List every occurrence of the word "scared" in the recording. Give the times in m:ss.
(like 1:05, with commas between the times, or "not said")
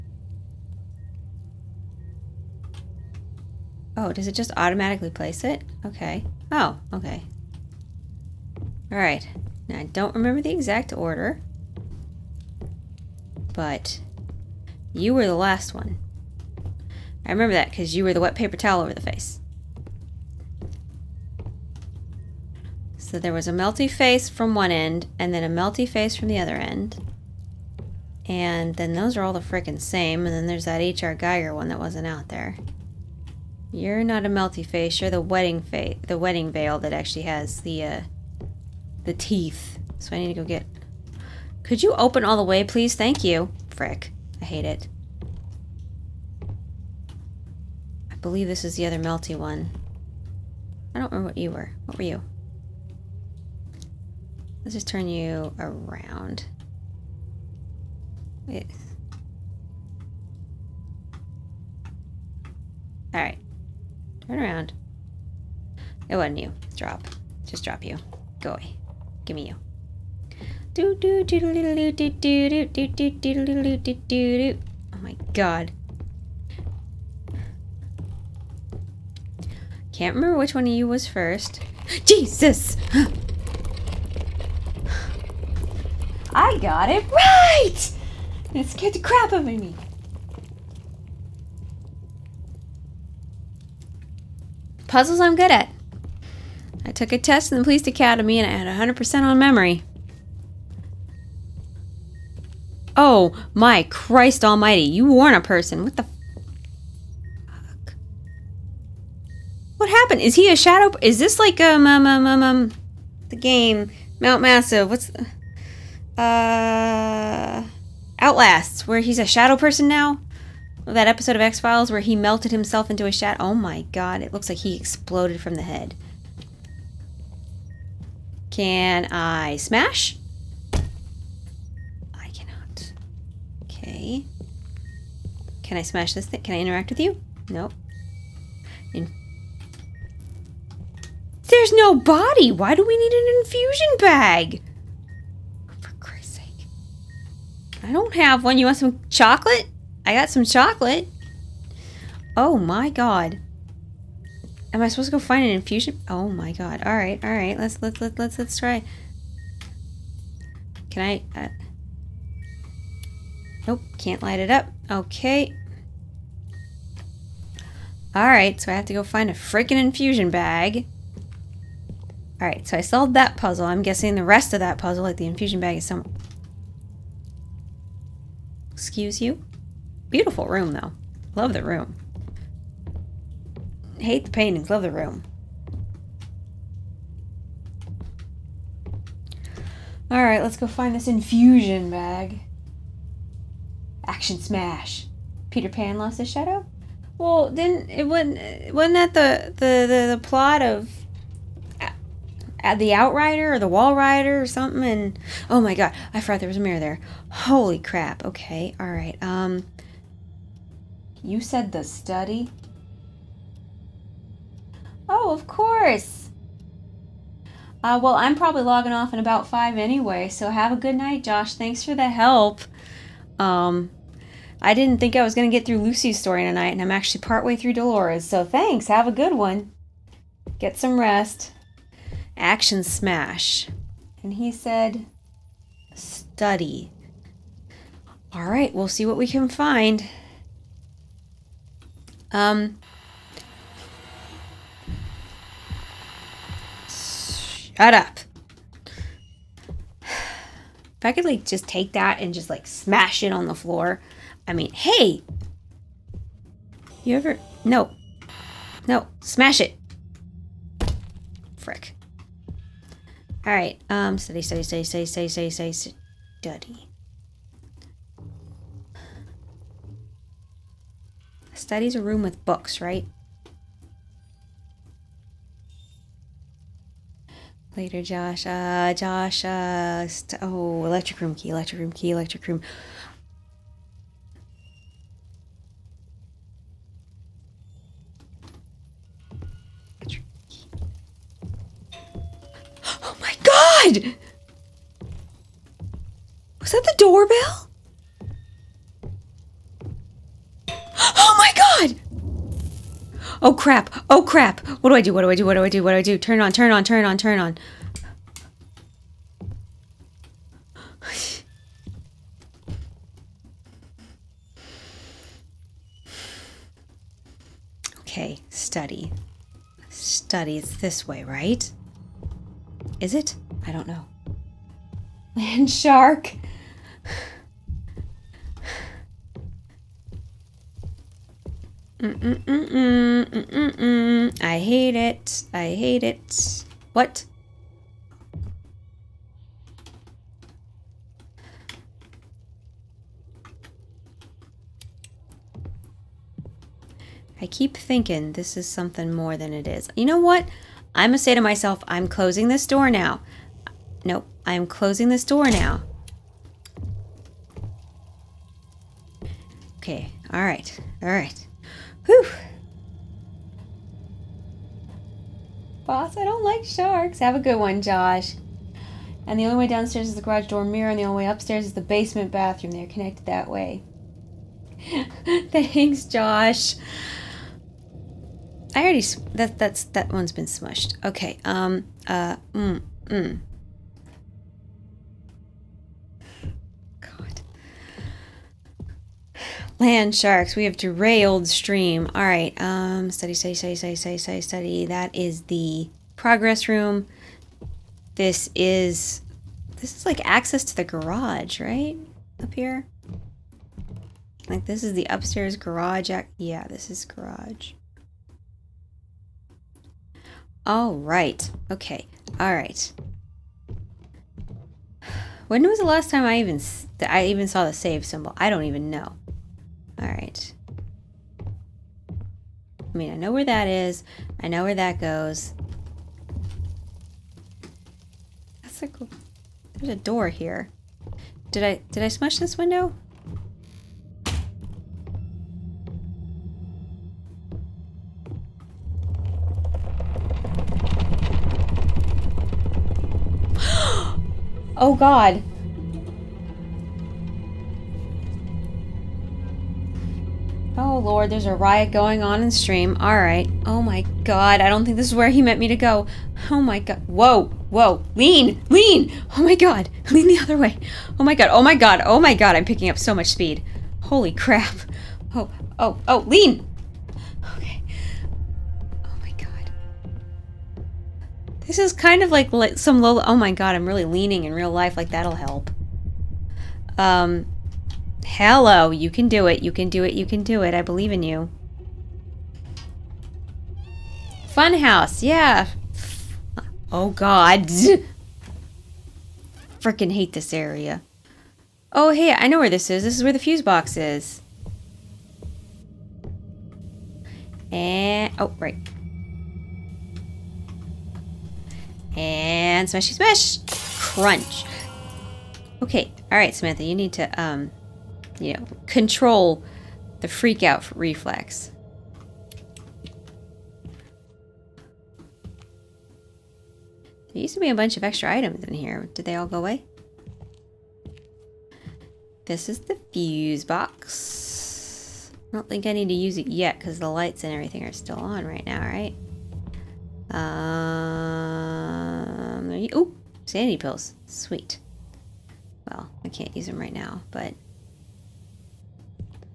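1:28.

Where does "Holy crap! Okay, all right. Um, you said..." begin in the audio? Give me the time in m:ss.
3:27.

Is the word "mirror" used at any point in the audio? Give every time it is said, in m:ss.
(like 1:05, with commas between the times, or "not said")
3:26, 6:10.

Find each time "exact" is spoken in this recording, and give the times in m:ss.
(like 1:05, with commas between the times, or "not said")
0:10.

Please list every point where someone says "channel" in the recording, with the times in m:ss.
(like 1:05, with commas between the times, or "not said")
not said.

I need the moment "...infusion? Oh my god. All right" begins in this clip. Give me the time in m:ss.
2:35.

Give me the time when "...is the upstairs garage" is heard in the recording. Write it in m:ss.
6:44.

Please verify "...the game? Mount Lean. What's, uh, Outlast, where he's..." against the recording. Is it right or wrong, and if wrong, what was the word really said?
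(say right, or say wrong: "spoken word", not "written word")
wrong: "Massive", not "Lean".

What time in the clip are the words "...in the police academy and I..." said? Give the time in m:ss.
1:37.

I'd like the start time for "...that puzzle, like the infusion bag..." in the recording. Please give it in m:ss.
2:54.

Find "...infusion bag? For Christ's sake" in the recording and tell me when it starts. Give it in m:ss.
2:23.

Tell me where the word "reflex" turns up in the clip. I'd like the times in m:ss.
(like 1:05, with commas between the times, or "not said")
8:30.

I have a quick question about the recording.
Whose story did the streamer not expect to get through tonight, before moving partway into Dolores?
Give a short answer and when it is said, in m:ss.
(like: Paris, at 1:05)
Lucy's, at 3:45.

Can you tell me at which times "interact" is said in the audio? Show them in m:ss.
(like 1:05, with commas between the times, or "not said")
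2:16.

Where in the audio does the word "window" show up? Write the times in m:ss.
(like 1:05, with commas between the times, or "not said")
7:12.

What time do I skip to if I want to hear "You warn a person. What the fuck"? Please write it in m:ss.
1:44.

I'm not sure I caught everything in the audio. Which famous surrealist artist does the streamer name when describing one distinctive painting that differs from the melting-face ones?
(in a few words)
H.R. Giger.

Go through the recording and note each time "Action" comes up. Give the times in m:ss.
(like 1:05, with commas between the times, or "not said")
3:14, 3:52.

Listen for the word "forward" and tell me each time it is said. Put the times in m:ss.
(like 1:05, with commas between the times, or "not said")
not said.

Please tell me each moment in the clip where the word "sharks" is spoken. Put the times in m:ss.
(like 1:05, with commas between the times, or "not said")
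5:25, 6:06, 6:30.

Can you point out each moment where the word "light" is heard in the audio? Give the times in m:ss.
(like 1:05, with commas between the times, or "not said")
2:44, 8:47.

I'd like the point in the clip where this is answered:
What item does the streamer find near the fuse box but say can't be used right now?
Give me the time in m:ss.
8:53.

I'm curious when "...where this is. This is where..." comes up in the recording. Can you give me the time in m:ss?
8:12.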